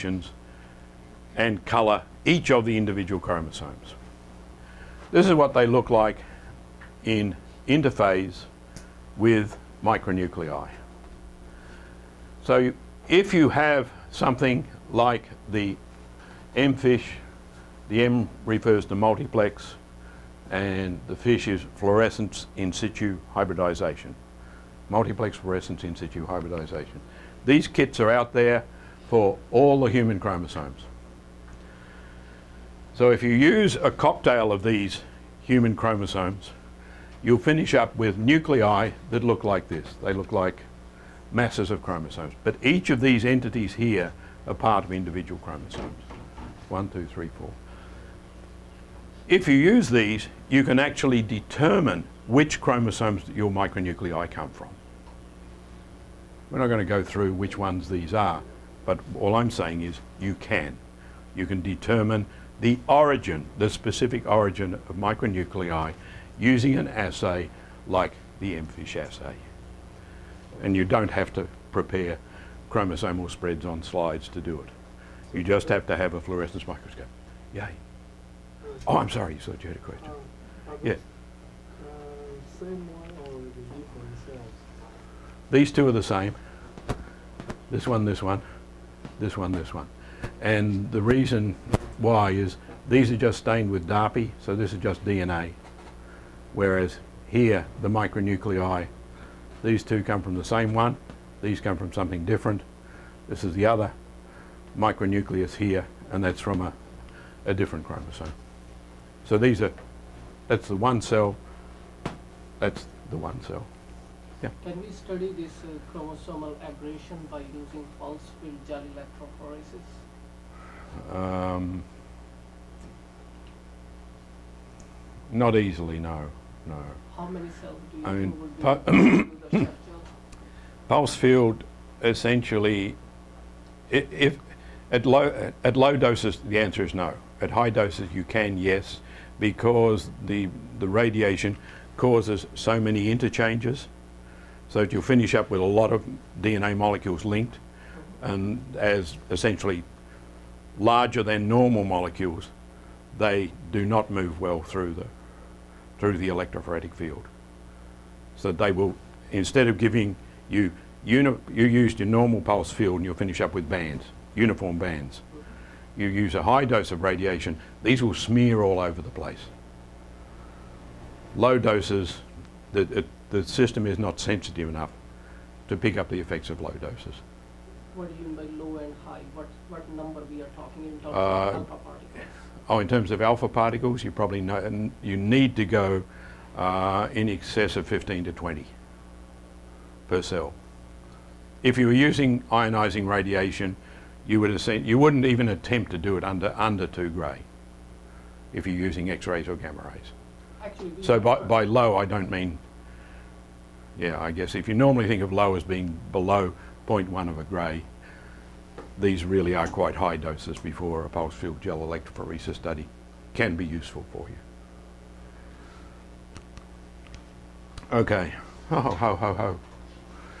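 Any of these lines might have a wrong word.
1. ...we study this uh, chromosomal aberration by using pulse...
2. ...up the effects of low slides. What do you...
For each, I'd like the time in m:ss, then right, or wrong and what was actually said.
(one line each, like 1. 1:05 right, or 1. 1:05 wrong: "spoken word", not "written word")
1. 1:54 right
2. 2:55 wrong: "doses", not "slides".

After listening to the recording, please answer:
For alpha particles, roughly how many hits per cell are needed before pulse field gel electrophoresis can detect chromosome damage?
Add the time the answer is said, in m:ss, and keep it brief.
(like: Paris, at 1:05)
15 to 20, at 3:07.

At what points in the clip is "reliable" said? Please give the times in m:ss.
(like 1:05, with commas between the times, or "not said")
not said.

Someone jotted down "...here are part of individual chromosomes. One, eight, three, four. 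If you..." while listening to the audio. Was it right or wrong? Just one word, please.
wrong.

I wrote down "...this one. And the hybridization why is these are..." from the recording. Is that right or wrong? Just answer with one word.
wrong.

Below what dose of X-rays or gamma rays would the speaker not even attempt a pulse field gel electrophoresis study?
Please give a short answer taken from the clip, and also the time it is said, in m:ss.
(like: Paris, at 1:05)
2 gray, at 3:16.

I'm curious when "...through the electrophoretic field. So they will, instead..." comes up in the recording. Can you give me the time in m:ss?
2:35.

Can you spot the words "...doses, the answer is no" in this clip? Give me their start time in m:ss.
2:15.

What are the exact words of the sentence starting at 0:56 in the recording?
We're not going to go through which ones these are, but all I'm saying is you can.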